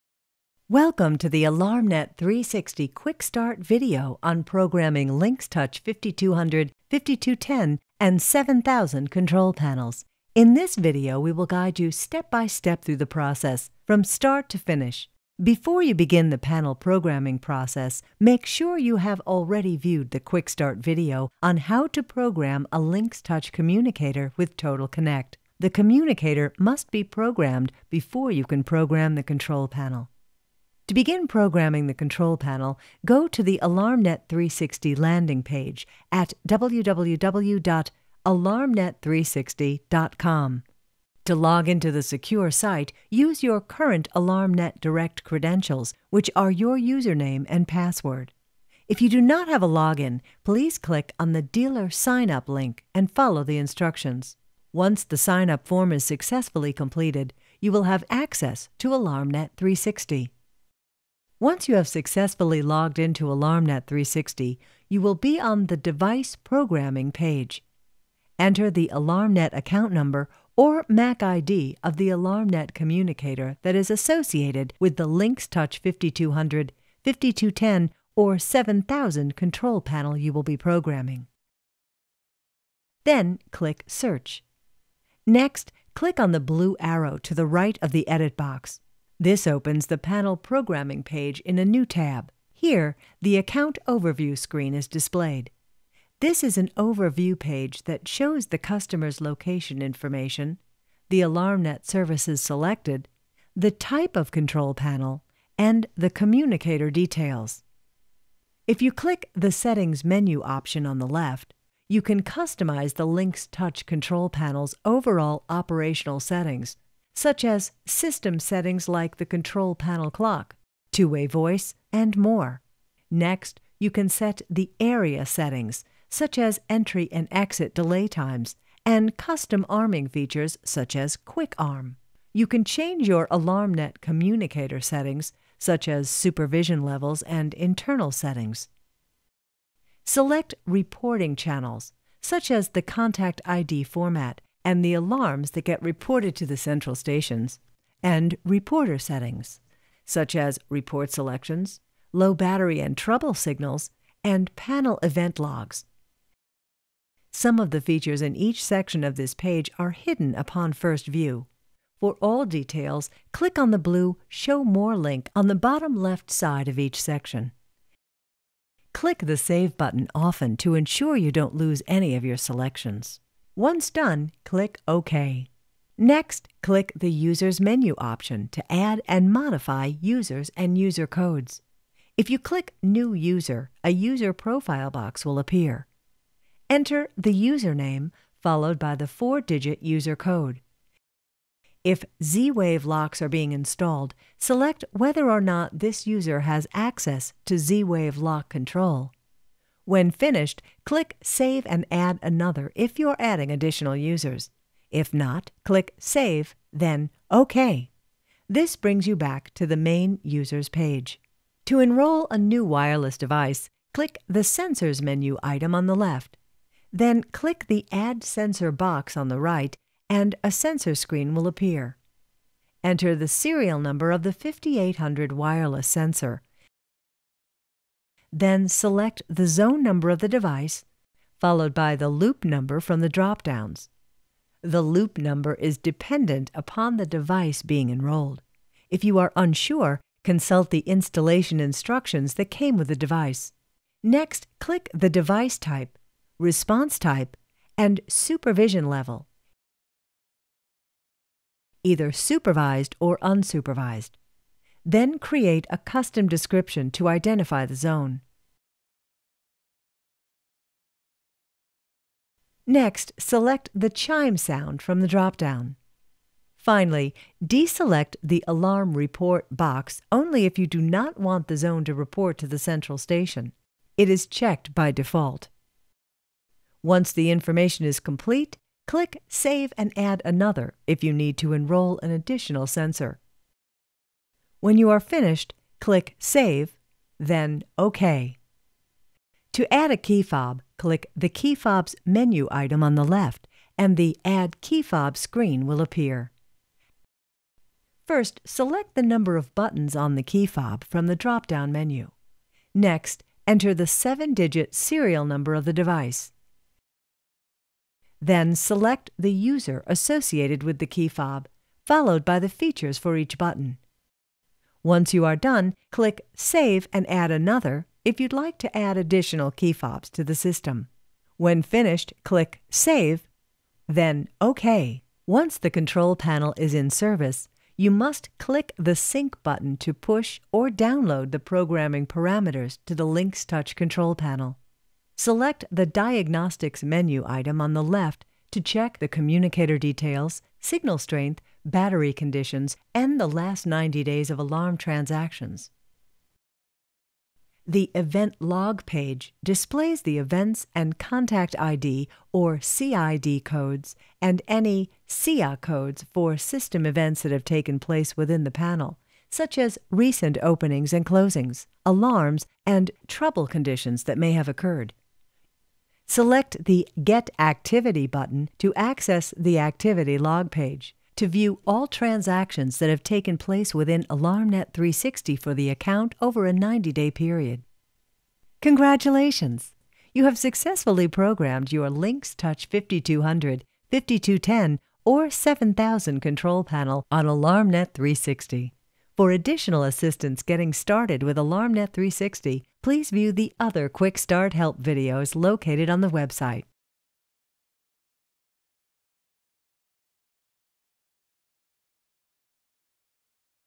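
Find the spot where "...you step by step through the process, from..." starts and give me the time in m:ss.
0:11.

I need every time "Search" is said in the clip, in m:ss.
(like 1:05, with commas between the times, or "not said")
1:23.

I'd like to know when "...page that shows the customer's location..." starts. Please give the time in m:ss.
1:37.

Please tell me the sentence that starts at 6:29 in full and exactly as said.
For additional assistance getting started with AlarmNet 360, please view the other Quick Start Help videos located on the website.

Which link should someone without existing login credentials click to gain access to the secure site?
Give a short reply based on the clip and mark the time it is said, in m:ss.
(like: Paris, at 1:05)
Dealer Sign Up, at 0:51.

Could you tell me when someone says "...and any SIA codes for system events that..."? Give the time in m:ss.
5:54.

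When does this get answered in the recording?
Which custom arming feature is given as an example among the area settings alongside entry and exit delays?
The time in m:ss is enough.
2:11.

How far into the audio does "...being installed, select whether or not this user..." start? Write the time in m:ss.
3:13.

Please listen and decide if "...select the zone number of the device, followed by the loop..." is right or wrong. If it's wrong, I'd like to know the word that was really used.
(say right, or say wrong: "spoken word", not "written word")
right.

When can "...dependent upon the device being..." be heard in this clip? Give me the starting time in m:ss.
3:55.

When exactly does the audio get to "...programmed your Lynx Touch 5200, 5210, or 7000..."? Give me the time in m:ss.
6:21.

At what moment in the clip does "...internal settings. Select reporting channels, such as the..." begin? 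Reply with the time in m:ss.
2:17.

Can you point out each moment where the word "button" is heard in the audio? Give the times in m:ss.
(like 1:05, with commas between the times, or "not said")
2:49, 4:59, 5:13, 5:29, 6:08.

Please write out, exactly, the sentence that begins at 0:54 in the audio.
Once the sign up form is successfully completed, you will have access to AlarmNet 360.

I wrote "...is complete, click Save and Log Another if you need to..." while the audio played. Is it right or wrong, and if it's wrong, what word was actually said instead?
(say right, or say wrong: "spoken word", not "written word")
wrong: "Add", not "Log".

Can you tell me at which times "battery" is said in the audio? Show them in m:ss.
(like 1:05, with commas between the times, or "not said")
2:32, 5:41.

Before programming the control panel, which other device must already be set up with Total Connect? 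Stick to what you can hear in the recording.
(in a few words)
Touch communicator.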